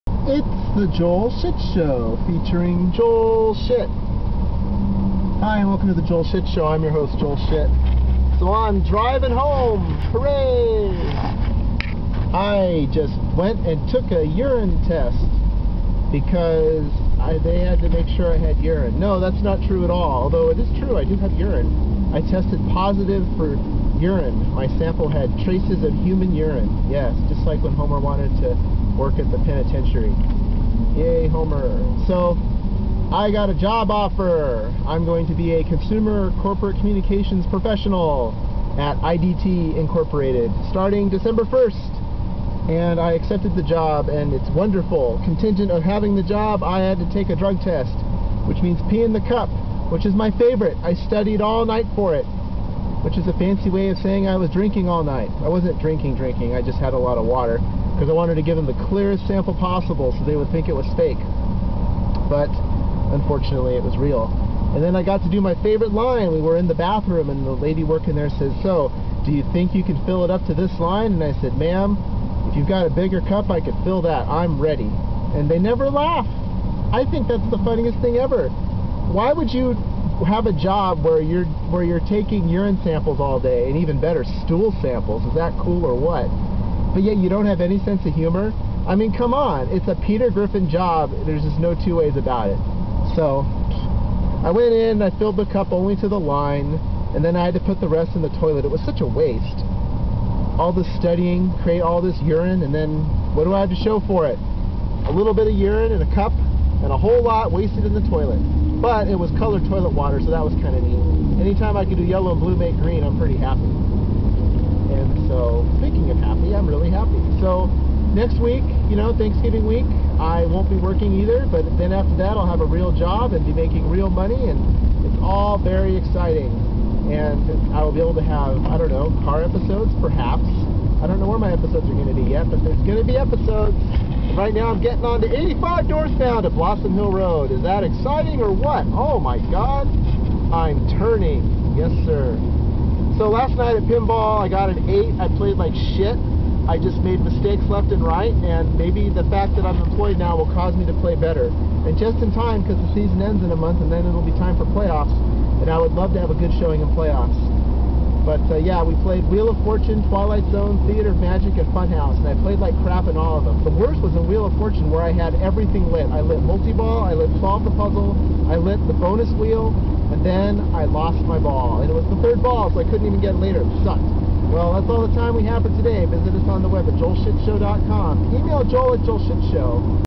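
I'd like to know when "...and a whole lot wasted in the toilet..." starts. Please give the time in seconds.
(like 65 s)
106 s.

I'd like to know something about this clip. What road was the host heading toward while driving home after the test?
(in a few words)
Blossom Hill Road.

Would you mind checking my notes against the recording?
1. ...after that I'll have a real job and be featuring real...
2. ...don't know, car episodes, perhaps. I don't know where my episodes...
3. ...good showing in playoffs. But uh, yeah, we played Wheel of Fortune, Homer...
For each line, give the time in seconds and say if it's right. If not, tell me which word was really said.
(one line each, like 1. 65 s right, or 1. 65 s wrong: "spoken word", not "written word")
1. 121 s wrong: "making", not "featuring"
2. 128 s right
3. 156 s wrong: "Twilight", not "Homer".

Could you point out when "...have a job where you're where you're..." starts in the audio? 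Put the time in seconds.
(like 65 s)
80 s.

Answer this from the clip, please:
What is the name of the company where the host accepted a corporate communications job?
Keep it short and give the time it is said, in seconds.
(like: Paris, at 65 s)
IDT Incorporated, at 39 s.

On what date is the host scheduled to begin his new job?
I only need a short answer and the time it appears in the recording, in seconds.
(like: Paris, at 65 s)
December 1st, at 41 s.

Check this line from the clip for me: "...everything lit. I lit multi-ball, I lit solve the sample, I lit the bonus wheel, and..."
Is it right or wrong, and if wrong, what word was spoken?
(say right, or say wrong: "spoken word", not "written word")
wrong: "puzzle", not "sample".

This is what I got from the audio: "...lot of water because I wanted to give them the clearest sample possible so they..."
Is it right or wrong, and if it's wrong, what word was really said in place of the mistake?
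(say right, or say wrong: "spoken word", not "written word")
right.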